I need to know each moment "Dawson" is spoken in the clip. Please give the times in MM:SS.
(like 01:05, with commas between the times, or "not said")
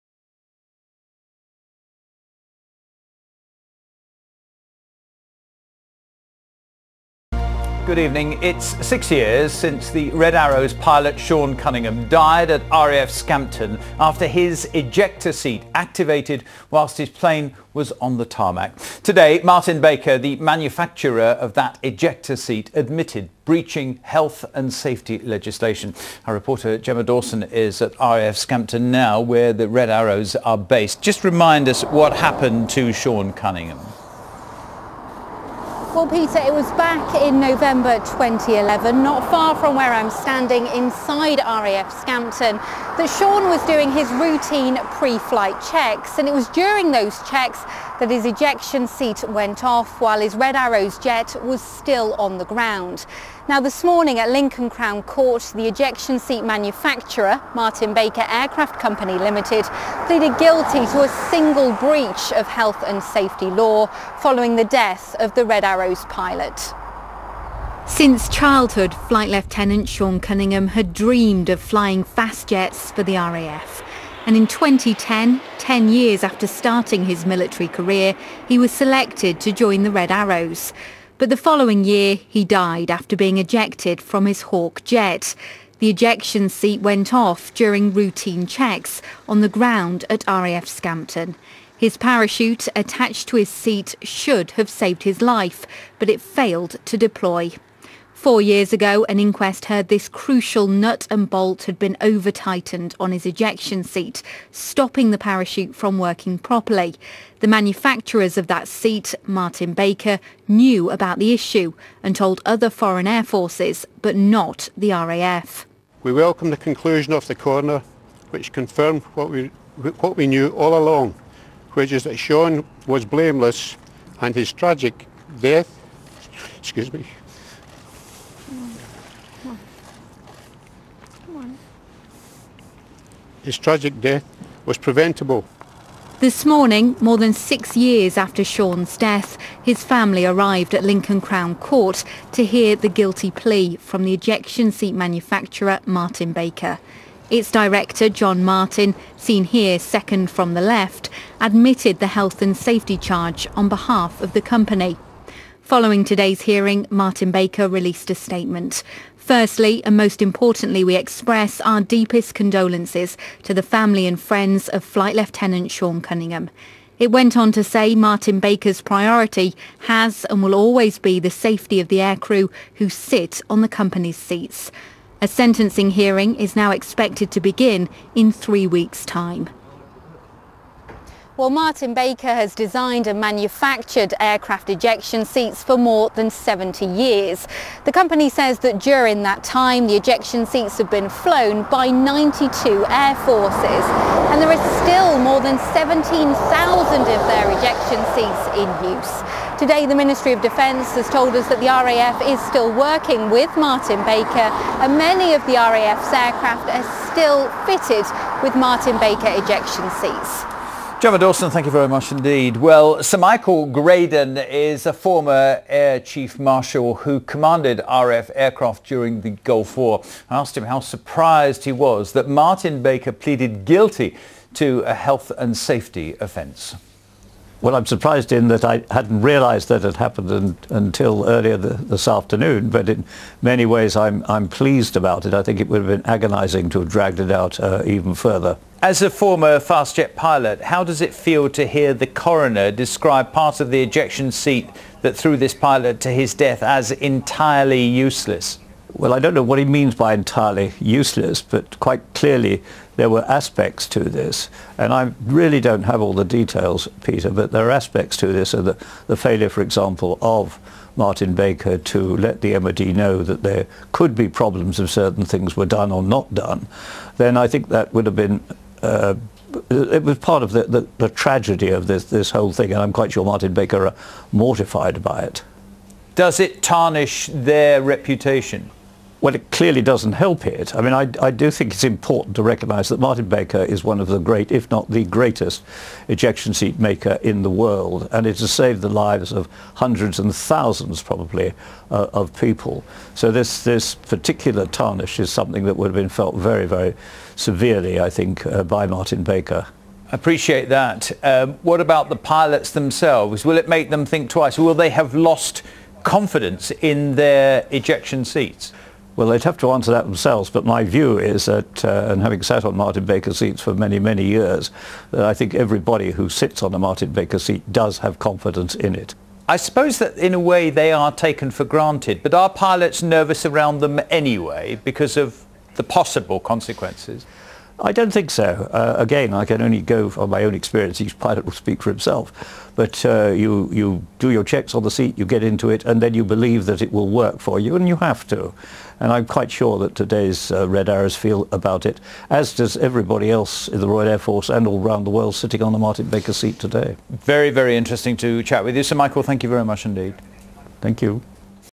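00:27, 03:31.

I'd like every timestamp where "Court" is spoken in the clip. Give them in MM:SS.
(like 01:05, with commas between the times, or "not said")
00:55, 02:21.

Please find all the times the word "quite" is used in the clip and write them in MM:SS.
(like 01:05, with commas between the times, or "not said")
04:11, 04:32, 05:39.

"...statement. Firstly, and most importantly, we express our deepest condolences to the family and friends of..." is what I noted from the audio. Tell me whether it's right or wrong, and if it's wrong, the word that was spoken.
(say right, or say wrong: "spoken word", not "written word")
right.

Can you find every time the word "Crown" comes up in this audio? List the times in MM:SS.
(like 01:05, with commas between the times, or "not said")
00:54, 02:21.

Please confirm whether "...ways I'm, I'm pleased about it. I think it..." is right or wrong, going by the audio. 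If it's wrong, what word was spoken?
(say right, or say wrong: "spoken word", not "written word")
right.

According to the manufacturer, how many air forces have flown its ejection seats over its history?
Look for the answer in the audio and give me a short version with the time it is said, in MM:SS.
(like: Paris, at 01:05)
92, at 03:11.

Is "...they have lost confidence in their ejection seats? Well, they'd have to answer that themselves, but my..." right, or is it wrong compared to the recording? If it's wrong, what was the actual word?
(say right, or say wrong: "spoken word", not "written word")
right.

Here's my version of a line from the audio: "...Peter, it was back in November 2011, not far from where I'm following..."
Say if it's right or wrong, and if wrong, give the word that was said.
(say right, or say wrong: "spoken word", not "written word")
wrong: "standing", not "following".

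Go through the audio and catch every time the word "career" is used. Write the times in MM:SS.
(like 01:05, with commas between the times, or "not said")
01:17.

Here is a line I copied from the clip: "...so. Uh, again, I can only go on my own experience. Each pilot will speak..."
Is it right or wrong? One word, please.
right.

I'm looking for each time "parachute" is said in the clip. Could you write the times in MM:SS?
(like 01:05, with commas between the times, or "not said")
01:31, 01:45.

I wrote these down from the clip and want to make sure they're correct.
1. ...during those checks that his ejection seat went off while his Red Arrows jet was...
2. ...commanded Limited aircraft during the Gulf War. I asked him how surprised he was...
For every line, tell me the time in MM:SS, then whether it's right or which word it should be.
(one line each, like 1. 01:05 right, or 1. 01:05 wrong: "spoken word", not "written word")
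1. 00:46 right
2. 03:37 wrong: "RAF", not "Limited".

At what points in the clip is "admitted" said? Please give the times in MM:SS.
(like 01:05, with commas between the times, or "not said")
00:22, 02:31.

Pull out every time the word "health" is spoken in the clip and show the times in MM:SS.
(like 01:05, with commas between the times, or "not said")
00:24, 01:02, 02:32, 03:44.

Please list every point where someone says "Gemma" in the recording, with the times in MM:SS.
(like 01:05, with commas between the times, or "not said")
00:26, 03:31.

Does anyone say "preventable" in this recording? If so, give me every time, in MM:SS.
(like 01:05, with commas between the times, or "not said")
02:14.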